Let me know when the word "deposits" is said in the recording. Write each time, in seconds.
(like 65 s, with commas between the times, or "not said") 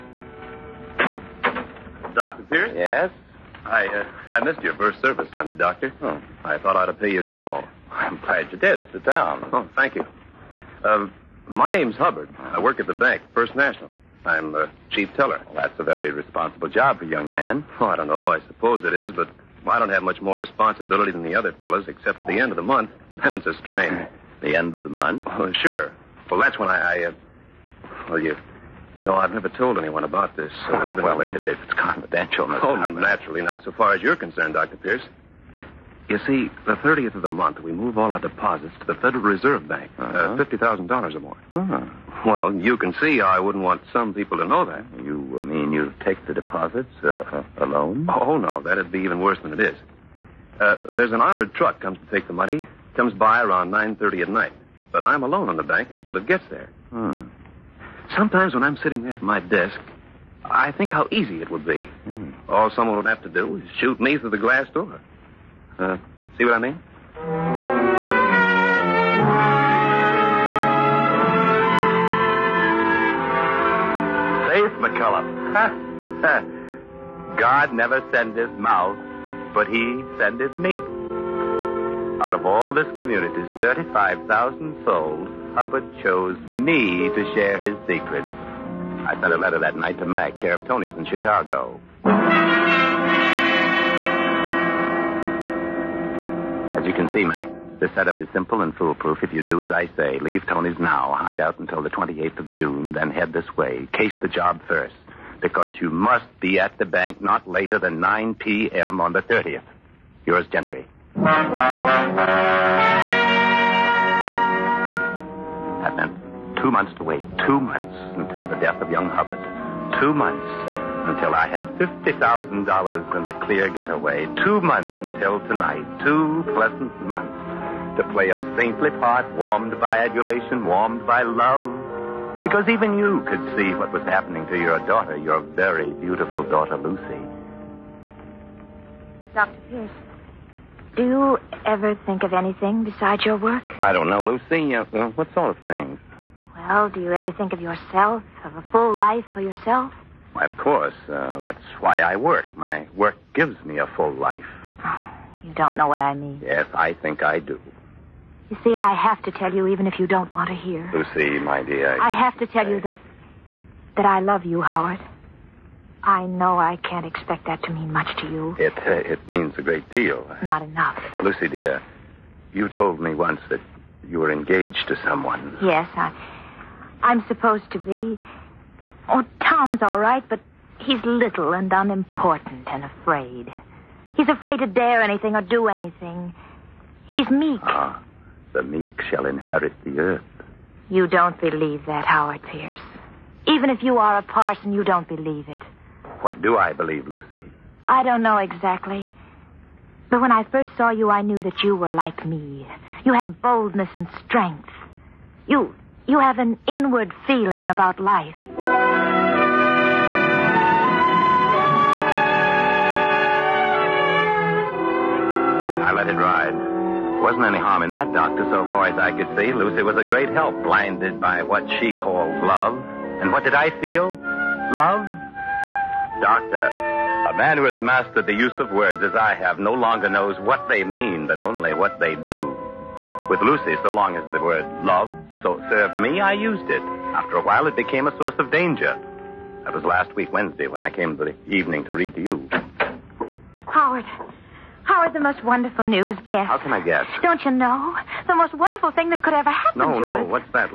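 38 s, 46 s.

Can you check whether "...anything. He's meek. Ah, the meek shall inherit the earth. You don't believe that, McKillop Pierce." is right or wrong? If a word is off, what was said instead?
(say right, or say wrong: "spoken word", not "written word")
wrong: "Howard", not "McKillop".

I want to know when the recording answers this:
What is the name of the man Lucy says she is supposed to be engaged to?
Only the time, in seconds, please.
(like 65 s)
179 s.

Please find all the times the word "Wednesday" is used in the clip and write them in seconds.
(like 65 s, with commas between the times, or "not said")
240 s.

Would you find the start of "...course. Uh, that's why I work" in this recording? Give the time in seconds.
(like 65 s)
150 s.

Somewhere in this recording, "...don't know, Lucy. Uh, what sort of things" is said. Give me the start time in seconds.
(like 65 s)
143 s.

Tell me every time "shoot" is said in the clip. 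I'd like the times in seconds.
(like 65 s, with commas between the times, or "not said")
63 s.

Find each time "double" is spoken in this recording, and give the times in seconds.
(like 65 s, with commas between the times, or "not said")
not said.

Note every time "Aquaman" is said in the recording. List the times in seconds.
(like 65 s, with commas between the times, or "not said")
not said.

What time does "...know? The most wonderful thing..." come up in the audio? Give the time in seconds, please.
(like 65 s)
247 s.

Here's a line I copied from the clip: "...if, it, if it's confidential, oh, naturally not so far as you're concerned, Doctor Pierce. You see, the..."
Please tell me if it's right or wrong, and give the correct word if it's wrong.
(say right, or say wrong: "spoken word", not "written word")
right.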